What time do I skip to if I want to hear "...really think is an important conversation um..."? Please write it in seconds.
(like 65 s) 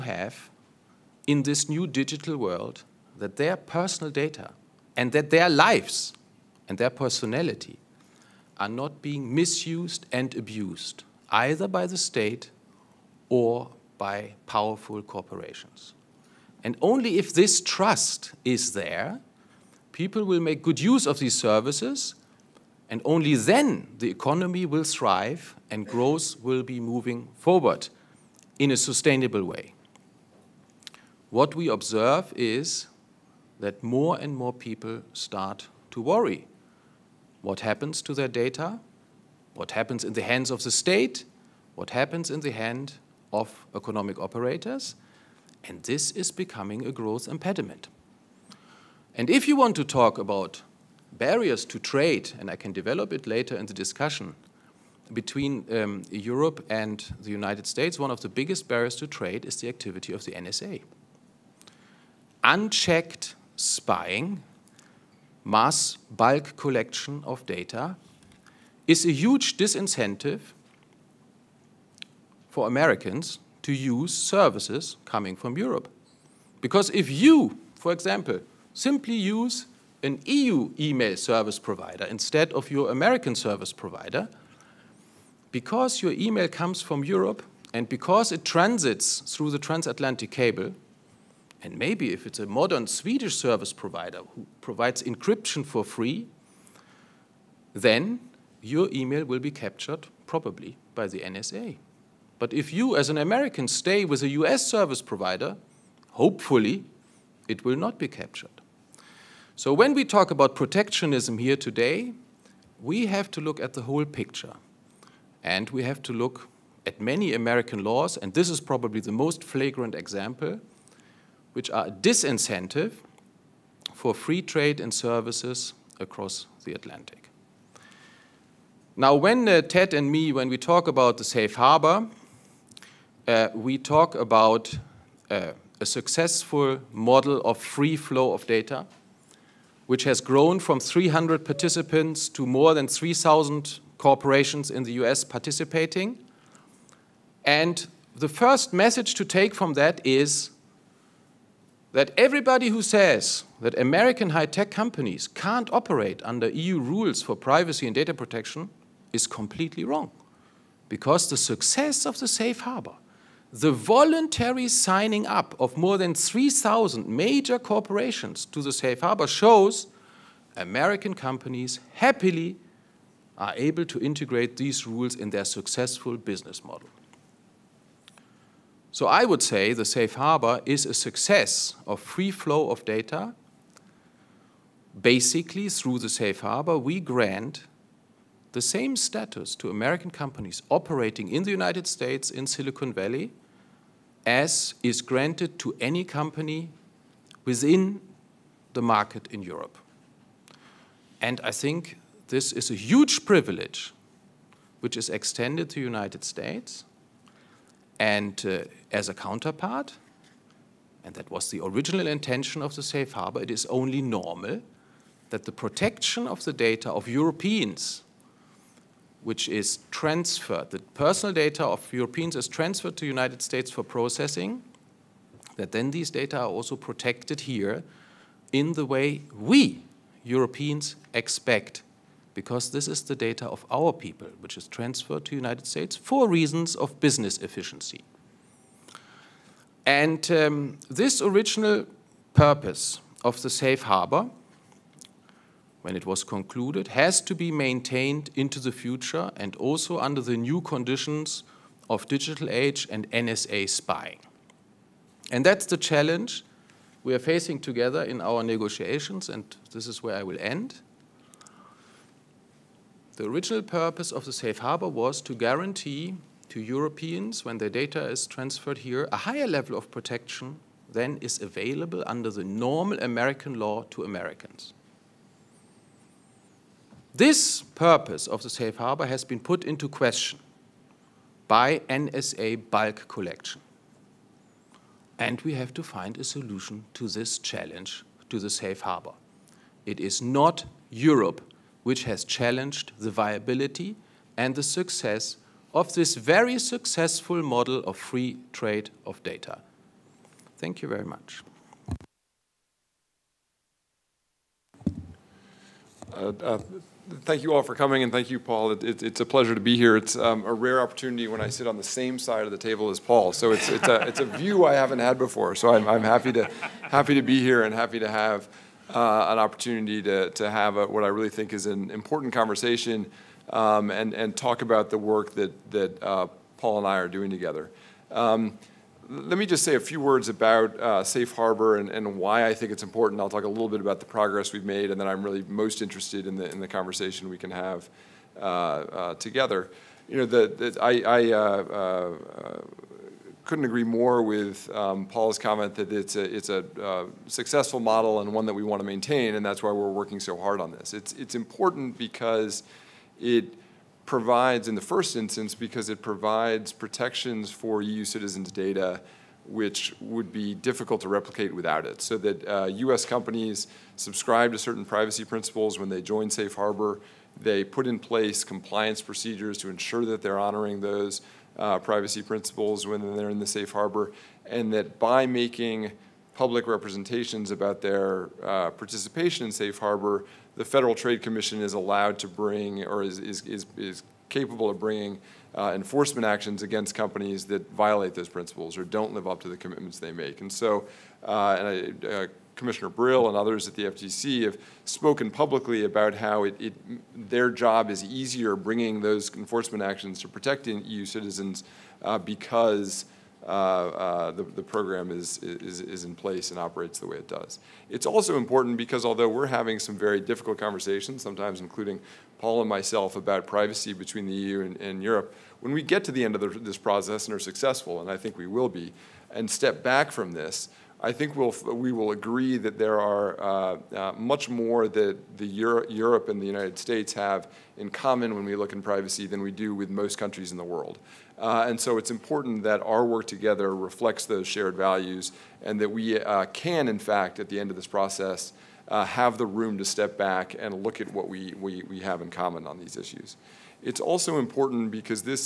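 321 s.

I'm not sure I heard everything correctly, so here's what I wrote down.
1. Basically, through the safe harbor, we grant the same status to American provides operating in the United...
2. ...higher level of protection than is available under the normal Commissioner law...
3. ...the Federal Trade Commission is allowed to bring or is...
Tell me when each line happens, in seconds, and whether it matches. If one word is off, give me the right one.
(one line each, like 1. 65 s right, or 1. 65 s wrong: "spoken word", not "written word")
1. 185 s wrong: "companies", not "provides"
2. 269 s wrong: "American", not "Commissioner"
3. 380 s right.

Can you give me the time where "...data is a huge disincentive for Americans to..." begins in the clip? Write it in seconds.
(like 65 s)
67 s.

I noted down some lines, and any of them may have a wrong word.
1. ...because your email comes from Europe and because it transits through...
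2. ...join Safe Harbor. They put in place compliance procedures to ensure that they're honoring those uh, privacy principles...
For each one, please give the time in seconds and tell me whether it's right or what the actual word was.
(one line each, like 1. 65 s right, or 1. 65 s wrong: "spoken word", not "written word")
1. 85 s right
2. 365 s right.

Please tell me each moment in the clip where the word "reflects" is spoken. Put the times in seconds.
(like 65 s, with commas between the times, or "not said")
433 s.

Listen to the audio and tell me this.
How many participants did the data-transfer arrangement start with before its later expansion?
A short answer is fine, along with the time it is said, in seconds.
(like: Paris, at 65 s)
300, at 140 s.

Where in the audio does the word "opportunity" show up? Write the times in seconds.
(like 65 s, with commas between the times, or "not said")
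310 s, 319 s.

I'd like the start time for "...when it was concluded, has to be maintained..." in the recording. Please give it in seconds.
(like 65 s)
245 s.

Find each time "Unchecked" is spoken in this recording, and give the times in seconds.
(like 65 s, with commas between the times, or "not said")
62 s.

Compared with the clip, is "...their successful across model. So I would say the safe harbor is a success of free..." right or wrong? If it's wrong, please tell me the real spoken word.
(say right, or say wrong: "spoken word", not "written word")
wrong: "business", not "across".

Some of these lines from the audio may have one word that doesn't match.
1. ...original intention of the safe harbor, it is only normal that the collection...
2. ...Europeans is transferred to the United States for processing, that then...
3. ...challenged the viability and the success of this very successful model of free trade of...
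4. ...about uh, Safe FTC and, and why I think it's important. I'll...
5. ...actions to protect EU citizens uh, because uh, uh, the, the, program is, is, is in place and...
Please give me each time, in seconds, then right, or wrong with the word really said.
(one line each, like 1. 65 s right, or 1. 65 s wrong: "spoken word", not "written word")
1. 211 s wrong: "protection", not "collection"
2. 221 s right
3. 292 s right
4. 330 s wrong: "Harbor", not "FTC"
5. 399 s right.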